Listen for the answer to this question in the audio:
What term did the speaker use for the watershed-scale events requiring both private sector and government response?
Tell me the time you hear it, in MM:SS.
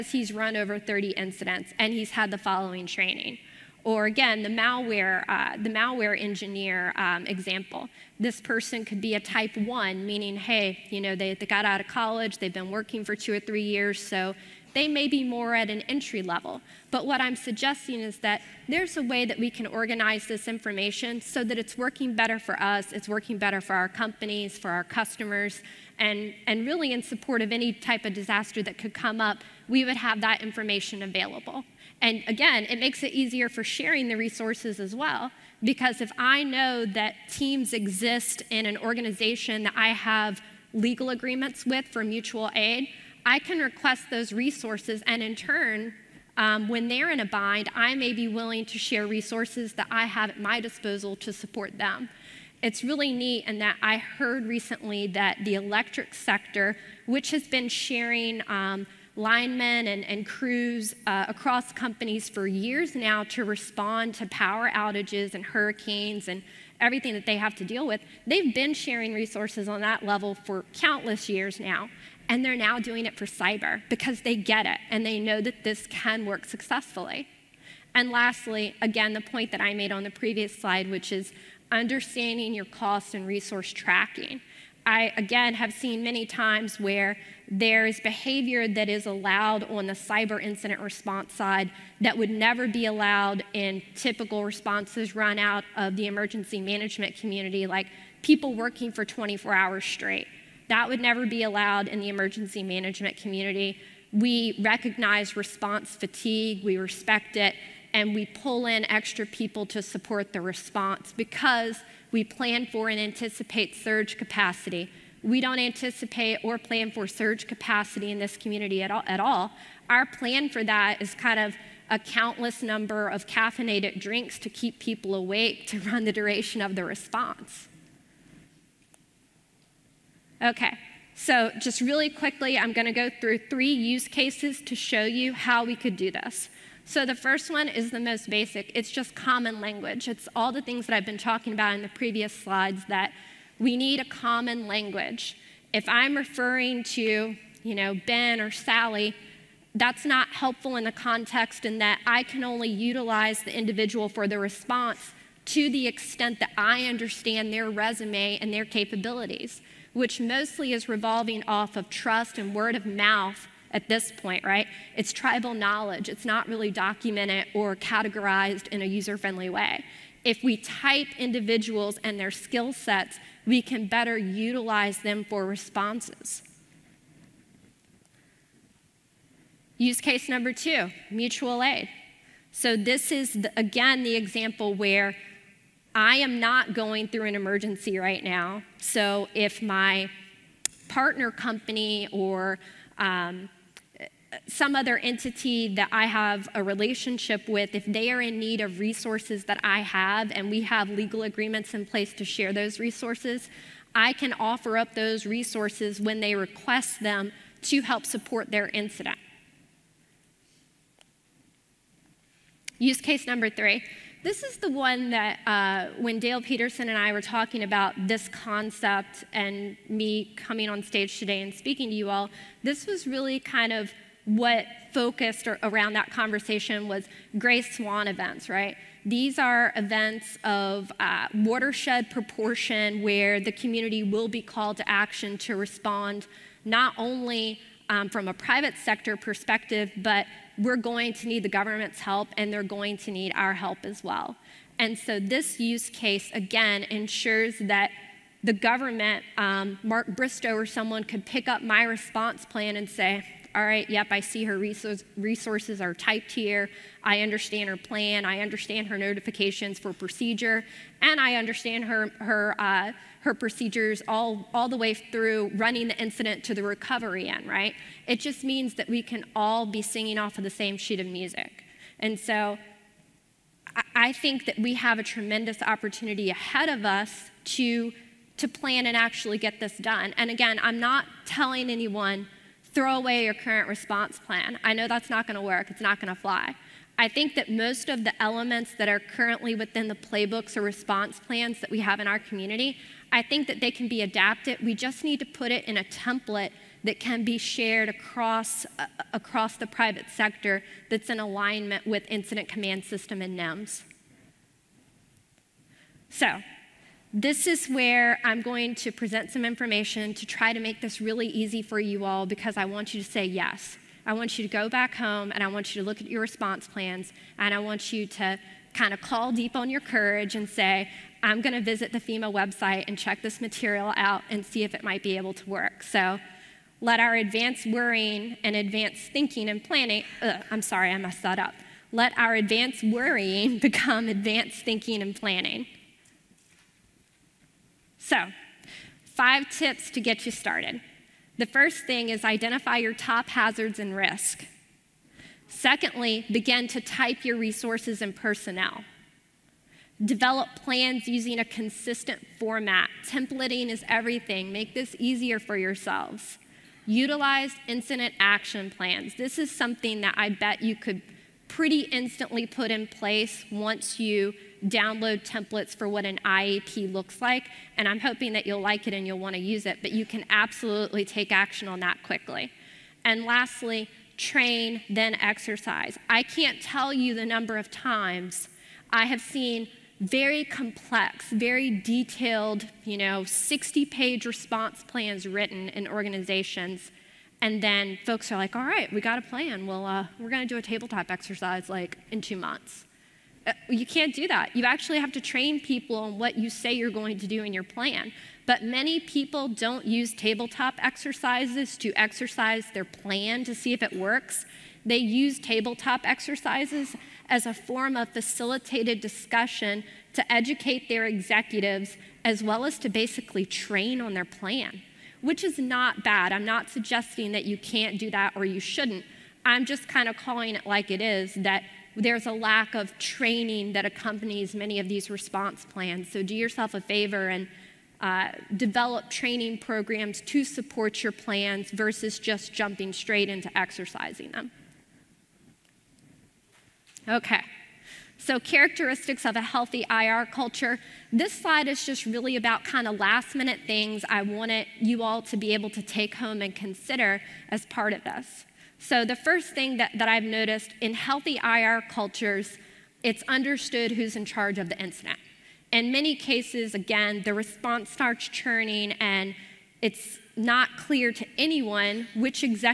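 03:47.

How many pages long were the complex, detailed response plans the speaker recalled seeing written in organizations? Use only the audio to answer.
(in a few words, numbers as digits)
60.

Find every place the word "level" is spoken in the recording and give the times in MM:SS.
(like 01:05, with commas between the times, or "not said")
00:16, 01:10.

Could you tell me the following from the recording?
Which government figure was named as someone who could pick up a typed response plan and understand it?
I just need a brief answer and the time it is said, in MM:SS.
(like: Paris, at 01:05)
Mark Bristow, at 04:09.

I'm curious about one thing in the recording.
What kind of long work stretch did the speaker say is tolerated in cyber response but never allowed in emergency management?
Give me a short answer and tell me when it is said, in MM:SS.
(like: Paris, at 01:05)
24 hours straight, at 01:39.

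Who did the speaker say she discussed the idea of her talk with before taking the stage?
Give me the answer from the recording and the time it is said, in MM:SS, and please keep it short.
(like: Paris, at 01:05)
Dale Peterson, at 03:36.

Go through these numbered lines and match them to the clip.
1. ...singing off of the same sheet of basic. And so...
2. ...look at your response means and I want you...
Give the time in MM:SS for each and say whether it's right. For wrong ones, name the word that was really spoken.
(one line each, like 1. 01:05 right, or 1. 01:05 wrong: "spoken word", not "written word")
1. 04:29 wrong: "music", not "basic"
2. 05:15 wrong: "plans", not "means".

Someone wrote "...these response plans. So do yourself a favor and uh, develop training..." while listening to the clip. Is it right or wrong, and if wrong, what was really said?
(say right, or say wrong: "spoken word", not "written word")
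right.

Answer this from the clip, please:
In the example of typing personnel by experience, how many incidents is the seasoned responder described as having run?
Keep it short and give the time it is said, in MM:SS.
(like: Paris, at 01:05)
Over 30, at 00:00.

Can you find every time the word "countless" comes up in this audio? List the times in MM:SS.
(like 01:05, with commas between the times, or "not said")
01:10, 02:01.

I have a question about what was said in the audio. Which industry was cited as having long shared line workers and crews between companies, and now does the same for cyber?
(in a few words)
Electric sector.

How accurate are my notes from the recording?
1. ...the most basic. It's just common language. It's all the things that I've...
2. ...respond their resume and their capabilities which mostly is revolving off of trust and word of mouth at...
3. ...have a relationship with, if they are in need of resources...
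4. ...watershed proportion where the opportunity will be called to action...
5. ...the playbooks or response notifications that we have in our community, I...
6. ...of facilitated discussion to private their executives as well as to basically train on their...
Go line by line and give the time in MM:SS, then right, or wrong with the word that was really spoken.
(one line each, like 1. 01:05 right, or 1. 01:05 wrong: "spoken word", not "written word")
1. 02:17 right
2. 02:36 wrong: "understand", not "respond"
3. 03:16 right
4. 03:51 wrong: "community", not "opportunity"
5. 04:49 wrong: "plans", not "notifications"
6. 06:47 wrong: "educate", not "private".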